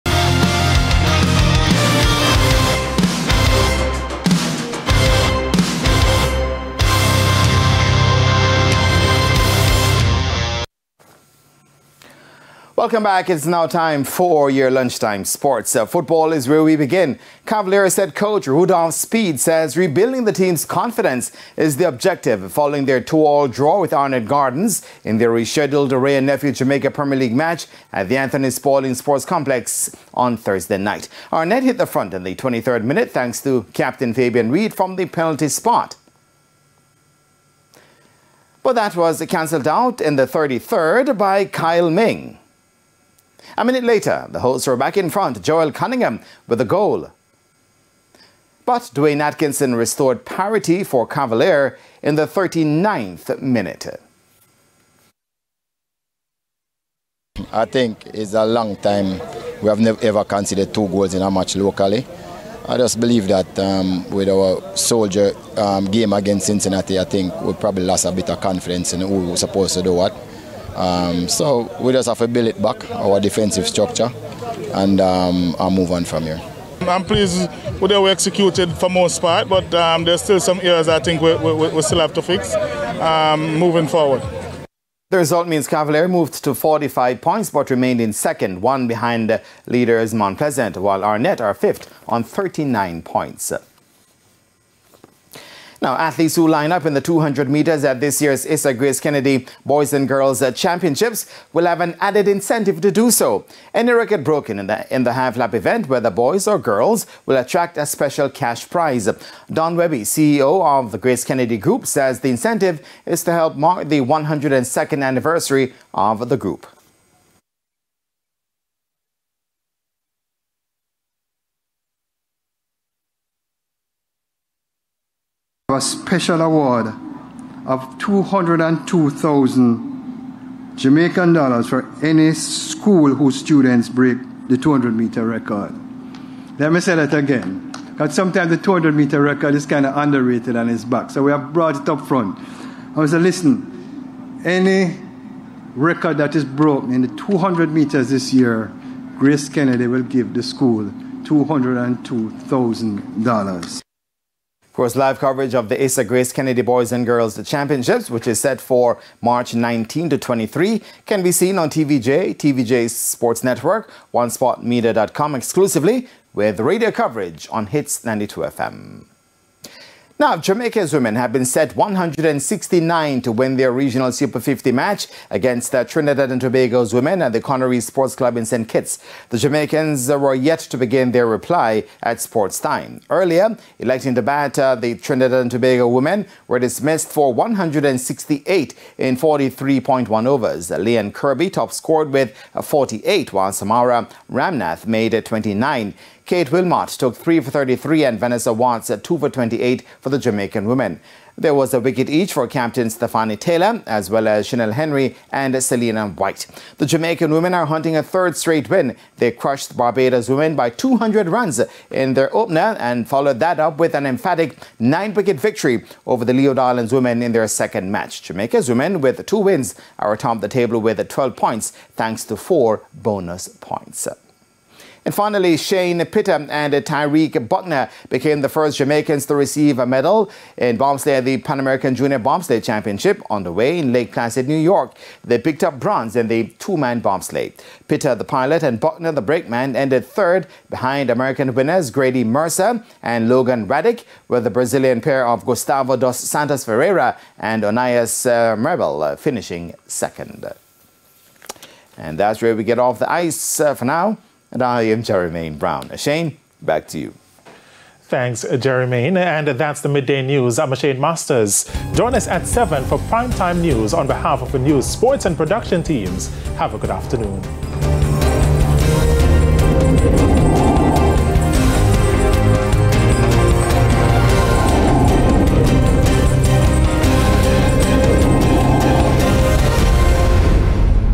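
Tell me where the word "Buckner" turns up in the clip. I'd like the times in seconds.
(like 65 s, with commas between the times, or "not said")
227 s, 238 s.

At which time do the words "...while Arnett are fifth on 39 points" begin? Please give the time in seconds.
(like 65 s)
90 s.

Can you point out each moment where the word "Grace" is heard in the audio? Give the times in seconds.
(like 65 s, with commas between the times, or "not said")
98 s, 110 s, 149 s, 156 s.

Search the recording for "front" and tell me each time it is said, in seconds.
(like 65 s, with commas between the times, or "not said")
31 s, 45 s, 142 s.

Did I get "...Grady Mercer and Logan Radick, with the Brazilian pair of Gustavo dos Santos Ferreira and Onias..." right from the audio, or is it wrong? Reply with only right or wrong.
right.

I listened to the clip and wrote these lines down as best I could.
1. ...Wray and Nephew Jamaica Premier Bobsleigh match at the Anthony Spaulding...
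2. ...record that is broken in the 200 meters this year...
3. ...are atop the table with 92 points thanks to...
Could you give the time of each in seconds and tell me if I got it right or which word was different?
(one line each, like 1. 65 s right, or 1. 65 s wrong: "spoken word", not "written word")
1. 25 s wrong: "League", not "Bobsleigh"
2. 145 s right
3. 219 s wrong: "12", not "92".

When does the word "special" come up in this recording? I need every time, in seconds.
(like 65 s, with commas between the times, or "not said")
107 s, 125 s.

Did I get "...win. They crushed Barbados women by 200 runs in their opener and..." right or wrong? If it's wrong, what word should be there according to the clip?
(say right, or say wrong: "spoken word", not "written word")
right.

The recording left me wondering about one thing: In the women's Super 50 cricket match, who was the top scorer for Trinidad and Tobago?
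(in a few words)
Lee-Ann Kirby.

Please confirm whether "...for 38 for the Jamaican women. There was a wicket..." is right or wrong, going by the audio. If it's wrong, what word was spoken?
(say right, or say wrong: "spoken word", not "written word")
wrong: "28", not "38".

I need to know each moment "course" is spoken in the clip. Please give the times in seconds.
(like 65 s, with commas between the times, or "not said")
154 s.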